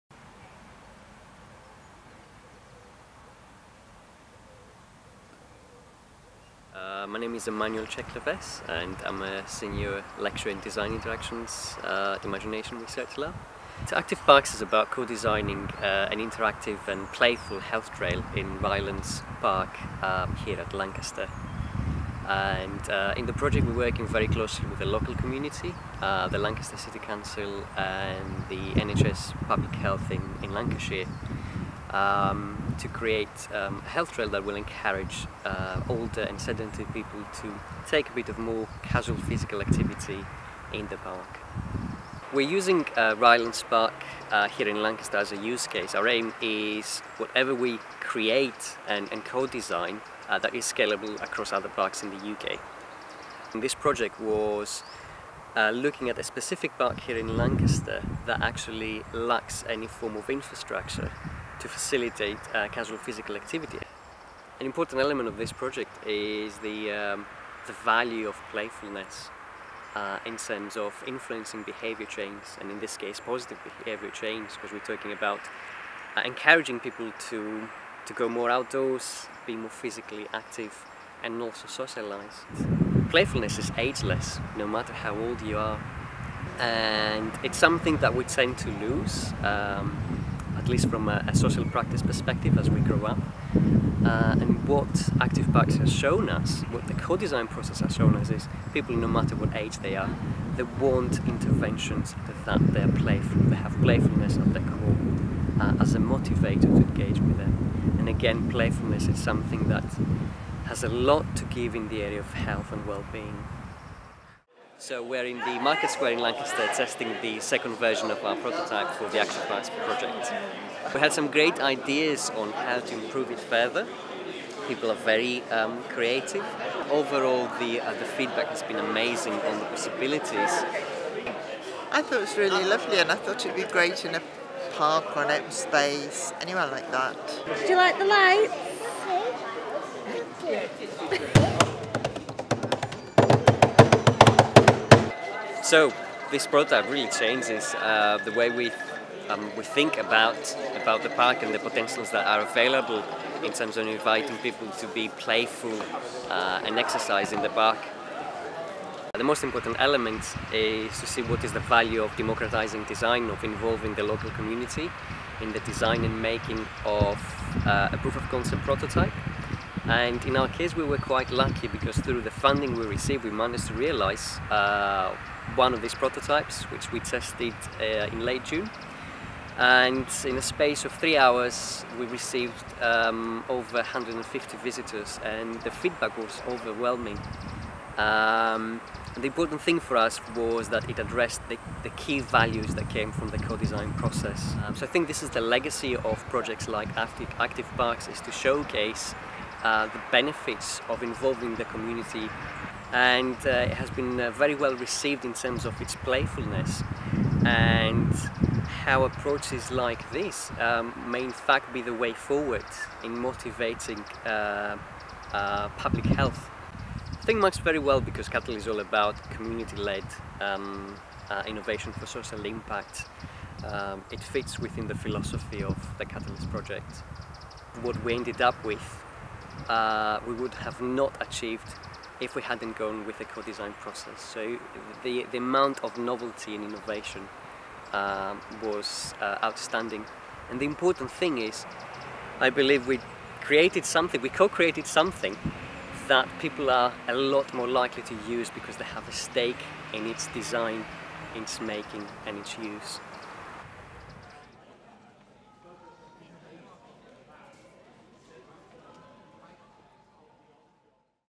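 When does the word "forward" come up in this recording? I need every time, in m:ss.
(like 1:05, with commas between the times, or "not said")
3:32.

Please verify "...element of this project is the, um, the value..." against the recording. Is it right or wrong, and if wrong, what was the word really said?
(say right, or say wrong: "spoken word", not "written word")
right.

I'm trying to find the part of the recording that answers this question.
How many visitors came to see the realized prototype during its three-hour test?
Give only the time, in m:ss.
3:03.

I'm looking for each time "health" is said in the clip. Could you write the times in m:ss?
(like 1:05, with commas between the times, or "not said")
0:17, 0:29, 0:33, 1:52, 3:36.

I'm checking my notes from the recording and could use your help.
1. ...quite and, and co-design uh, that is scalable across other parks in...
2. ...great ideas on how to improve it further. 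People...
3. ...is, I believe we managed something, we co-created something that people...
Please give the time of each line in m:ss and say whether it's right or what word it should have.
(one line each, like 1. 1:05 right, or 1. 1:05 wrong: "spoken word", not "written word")
1. 0:47 wrong: "create", not "quite"
2. 2:01 right
3. 4:01 wrong: "created", not "managed".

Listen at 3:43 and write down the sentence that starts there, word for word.
Um, it fits within the philosophy of the Catalyst project.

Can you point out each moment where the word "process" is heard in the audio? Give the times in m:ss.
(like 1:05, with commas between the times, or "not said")
1:37, 3:13, 3:53.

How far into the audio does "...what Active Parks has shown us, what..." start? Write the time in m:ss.
1:34.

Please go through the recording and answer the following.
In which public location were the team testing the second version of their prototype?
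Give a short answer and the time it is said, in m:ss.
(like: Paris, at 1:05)
Market Square, at 1:55.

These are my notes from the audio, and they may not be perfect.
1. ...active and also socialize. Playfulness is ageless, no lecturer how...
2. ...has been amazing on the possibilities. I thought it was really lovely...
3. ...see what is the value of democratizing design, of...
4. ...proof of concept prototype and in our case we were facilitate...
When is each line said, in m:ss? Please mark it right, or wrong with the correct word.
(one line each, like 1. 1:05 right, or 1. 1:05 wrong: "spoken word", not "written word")
1. 1:20 wrong: "matter", not "lecturer"
2. 2:08 right
3. 2:41 right
4. 2:48 wrong: "quite", not "facilitate".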